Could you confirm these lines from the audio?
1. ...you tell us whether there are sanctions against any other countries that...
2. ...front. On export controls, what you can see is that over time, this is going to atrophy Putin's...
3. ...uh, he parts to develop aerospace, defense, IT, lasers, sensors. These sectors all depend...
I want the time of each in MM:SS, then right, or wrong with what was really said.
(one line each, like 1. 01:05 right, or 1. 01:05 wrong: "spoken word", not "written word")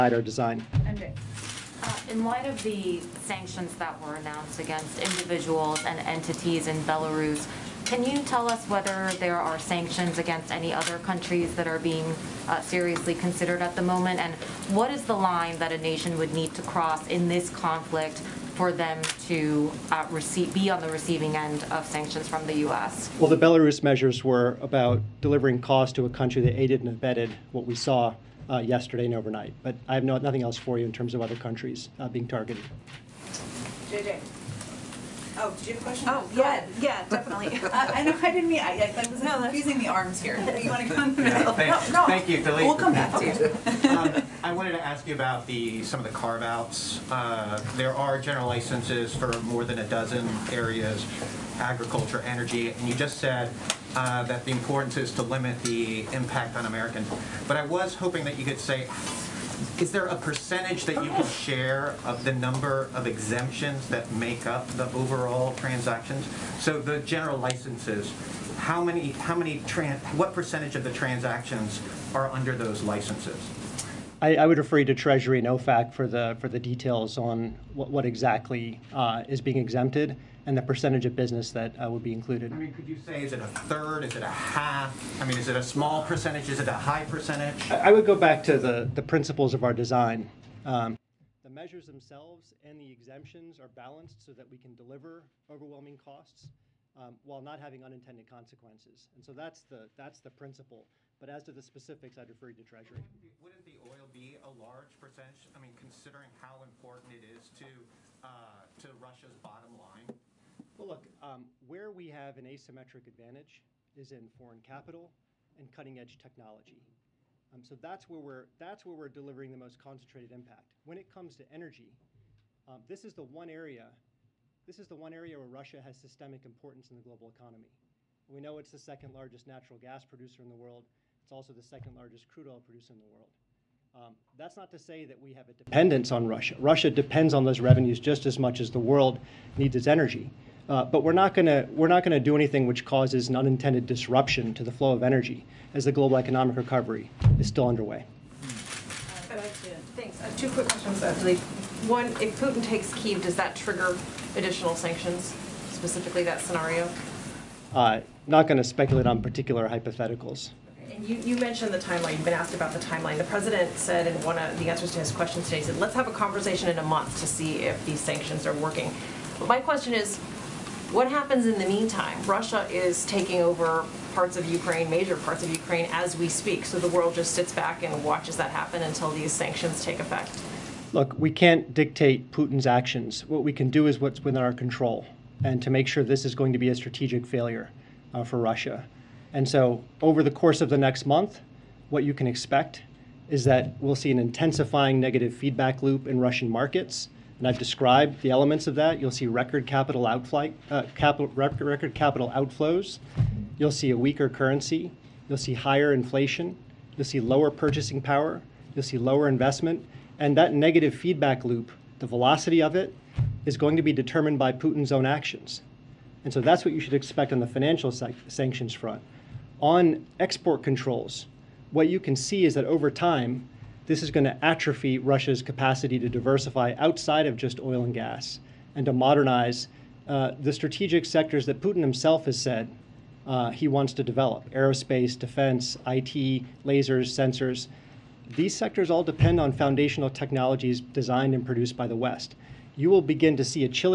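1. 00:08 right
2. 03:38 wrong: "Russia", not "Putin"
3. 03:53 wrong: "wants", not "parts".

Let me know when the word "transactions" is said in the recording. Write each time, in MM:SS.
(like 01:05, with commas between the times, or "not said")
01:05, 01:10.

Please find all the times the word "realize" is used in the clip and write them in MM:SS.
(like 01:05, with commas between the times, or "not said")
not said.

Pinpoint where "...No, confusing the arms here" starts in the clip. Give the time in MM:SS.
00:39.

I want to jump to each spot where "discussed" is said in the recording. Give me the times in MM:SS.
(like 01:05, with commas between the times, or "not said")
not said.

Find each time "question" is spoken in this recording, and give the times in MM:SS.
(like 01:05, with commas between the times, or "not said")
00:35, 02:30, 02:45, 02:49.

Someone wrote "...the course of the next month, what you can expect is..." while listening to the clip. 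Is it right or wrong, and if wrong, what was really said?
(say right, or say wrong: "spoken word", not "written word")
right.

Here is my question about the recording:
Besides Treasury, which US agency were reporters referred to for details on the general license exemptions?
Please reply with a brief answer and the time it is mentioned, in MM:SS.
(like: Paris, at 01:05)
OFAC, at 01:15.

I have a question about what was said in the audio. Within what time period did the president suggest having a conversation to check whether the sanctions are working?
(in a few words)
A month.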